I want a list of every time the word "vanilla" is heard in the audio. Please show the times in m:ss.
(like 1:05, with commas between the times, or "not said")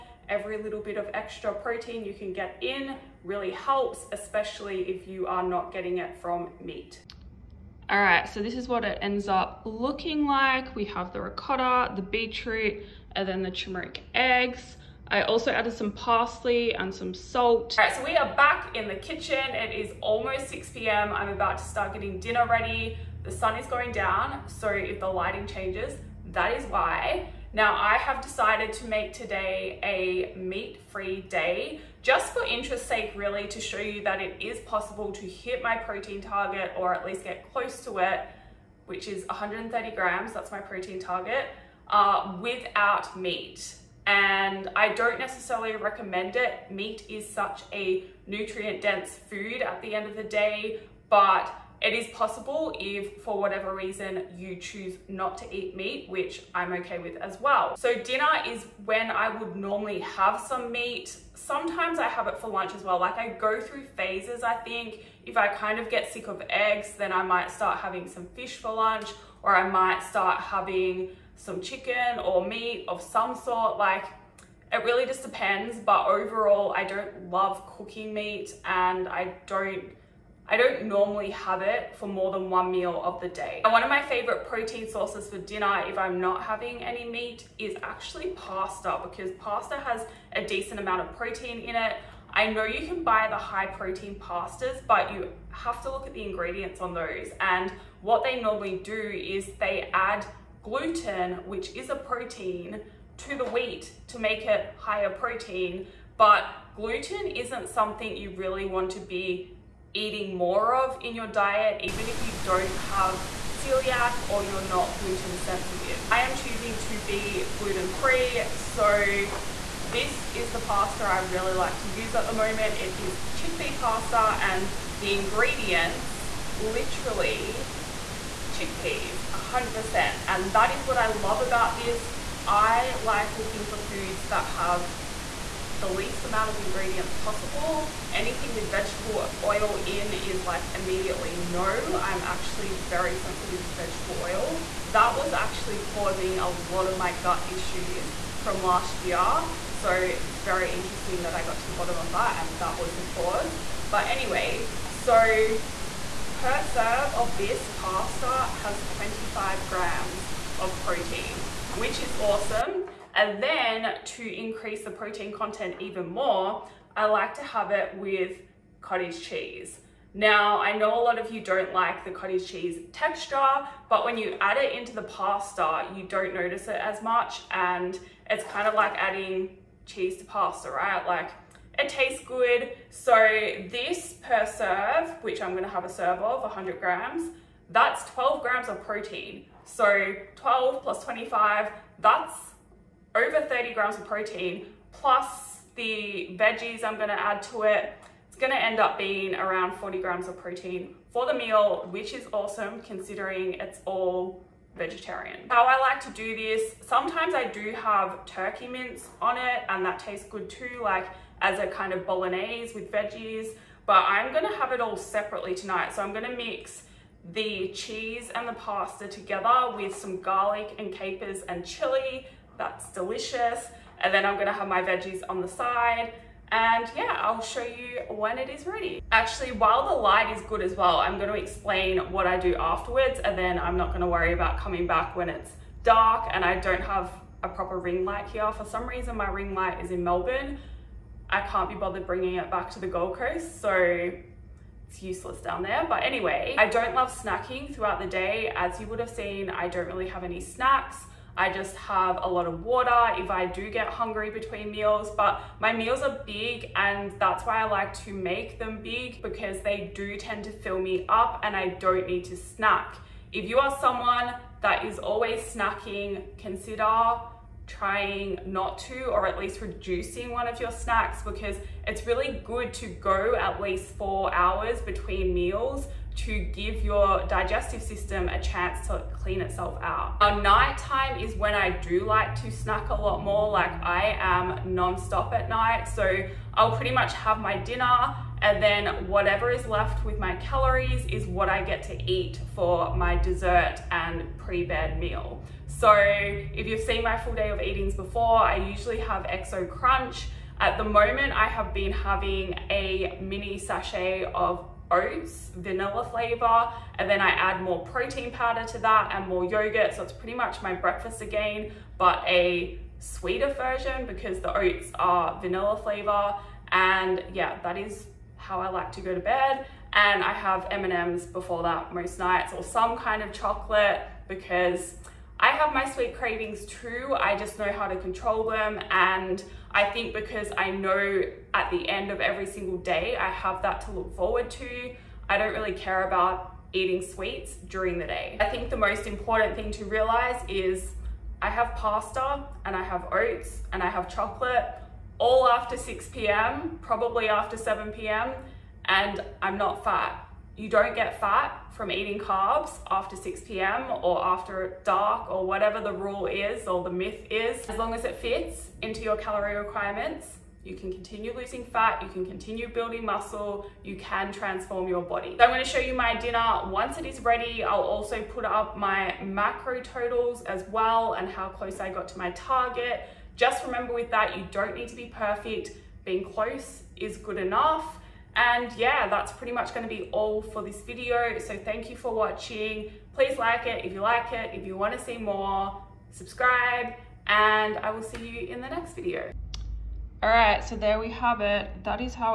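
5:05, 5:15.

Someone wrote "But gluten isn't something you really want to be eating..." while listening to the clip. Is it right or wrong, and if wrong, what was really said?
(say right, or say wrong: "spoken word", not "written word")
right.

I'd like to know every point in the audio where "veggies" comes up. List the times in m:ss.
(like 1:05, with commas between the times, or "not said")
3:16, 3:32, 3:44.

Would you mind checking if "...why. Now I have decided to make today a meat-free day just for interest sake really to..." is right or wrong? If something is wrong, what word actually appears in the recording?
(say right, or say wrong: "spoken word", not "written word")
right.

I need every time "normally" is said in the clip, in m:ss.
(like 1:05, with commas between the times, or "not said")
0:59, 1:20, 1:38.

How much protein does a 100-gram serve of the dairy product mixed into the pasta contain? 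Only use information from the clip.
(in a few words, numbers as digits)
12 grams.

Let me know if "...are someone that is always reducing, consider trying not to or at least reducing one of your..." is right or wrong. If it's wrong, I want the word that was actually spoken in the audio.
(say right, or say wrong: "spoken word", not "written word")
wrong: "snacking", not "reducing".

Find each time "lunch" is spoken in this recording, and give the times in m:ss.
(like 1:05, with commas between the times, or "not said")
1:02, 1:08.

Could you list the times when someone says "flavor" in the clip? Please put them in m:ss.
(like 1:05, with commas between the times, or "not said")
5:06, 5:15.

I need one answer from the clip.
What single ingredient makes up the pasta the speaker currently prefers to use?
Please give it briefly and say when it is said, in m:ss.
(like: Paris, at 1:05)
chickpeas, at 2:08.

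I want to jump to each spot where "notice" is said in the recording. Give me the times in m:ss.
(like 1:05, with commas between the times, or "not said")
2:56.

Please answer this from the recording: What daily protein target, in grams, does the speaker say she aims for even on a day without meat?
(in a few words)
130 grams.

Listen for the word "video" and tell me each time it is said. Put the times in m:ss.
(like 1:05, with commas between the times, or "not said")
6:20, 6:28.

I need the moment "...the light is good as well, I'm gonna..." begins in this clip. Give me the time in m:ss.
3:49.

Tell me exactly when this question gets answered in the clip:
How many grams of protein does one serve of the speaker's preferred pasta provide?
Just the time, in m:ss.
2:38.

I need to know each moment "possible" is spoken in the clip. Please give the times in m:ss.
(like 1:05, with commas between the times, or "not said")
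0:34, 0:52, 2:17.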